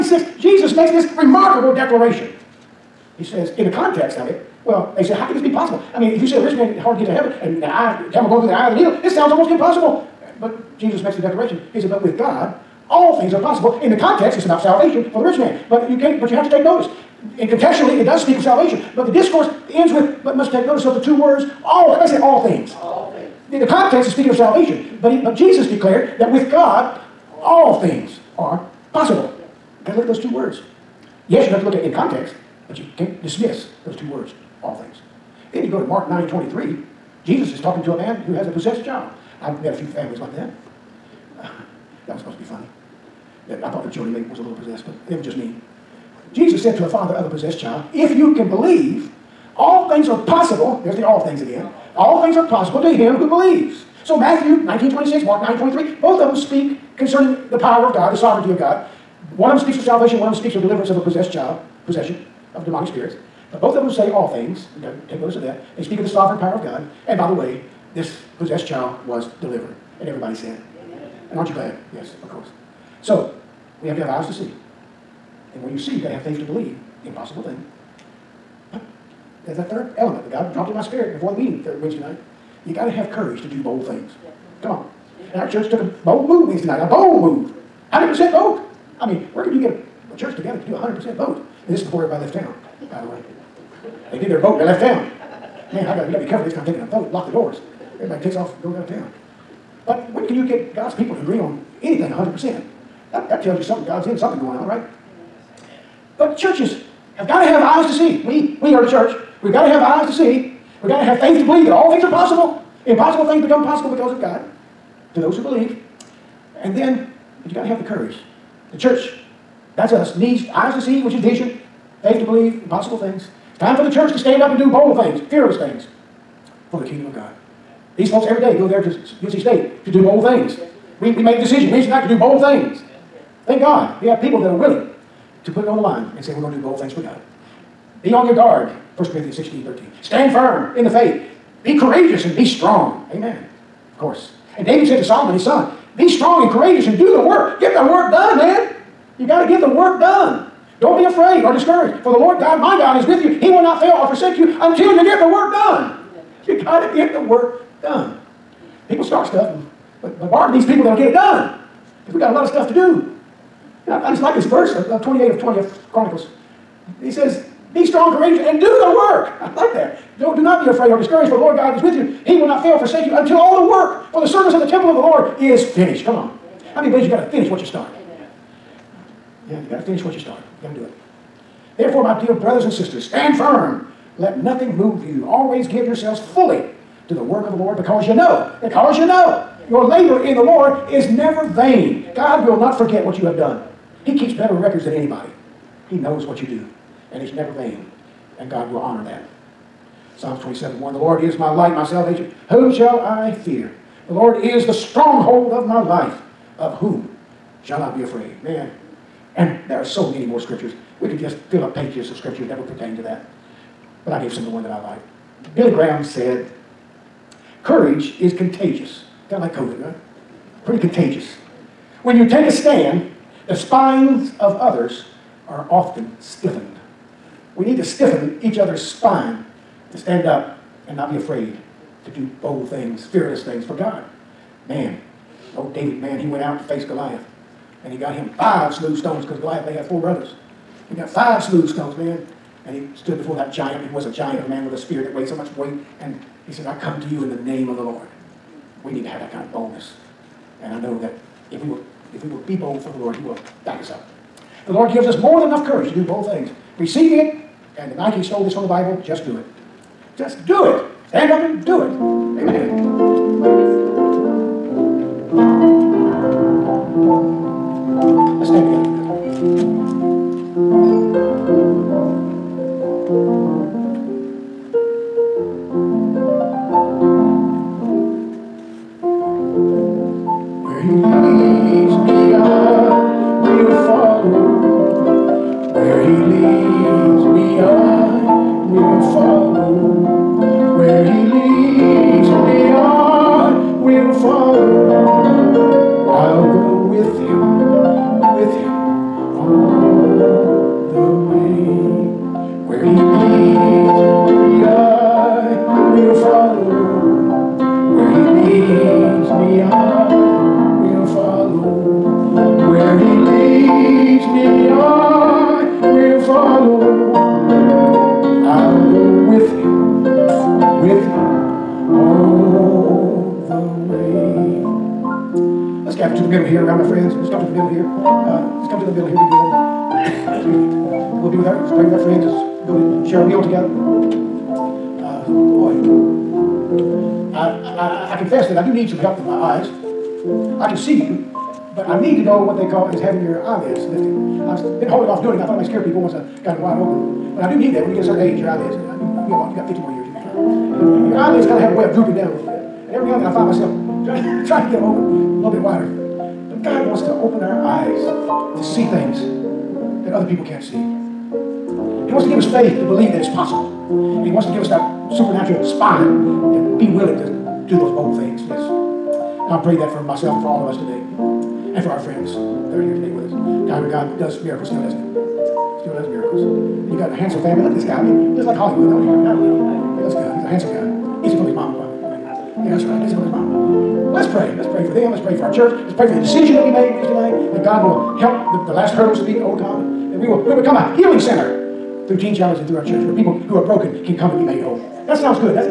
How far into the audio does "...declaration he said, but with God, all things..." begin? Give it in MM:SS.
00:11.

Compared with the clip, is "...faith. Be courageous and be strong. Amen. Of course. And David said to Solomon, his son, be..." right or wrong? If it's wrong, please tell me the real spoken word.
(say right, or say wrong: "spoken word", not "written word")
right.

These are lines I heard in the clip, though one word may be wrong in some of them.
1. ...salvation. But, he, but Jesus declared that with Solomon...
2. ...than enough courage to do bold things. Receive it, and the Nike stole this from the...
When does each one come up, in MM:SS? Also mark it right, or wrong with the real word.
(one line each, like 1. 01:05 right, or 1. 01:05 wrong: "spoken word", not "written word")
1. 00:24 wrong: "God", not "Solomon"
2. 04:15 right.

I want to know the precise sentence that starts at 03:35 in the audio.
Billy Graham said, Courage is contagious.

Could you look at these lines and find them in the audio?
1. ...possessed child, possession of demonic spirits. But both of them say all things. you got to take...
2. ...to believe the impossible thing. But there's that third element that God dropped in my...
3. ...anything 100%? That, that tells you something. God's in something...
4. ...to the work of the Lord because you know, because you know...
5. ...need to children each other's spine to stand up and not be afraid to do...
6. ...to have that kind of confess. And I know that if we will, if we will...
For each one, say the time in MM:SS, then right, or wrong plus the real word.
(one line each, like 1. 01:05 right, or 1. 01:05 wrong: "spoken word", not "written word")
1. 01:01 right
2. 01:16 right
3. 01:41 right
4. 03:07 right
5. 03:47 wrong: "stiffen", not "children"
6. 04:09 wrong: "boldness", not "confess".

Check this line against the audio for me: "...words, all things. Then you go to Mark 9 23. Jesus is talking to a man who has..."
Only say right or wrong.
right.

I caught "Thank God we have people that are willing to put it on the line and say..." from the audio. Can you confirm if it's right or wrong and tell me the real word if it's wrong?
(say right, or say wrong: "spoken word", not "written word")
right.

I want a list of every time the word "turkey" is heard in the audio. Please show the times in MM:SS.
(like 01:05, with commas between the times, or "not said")
not said.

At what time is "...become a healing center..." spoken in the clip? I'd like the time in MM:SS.
06:30.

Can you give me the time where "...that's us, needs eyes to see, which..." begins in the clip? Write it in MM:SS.
01:59.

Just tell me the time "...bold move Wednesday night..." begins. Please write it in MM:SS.
01:26.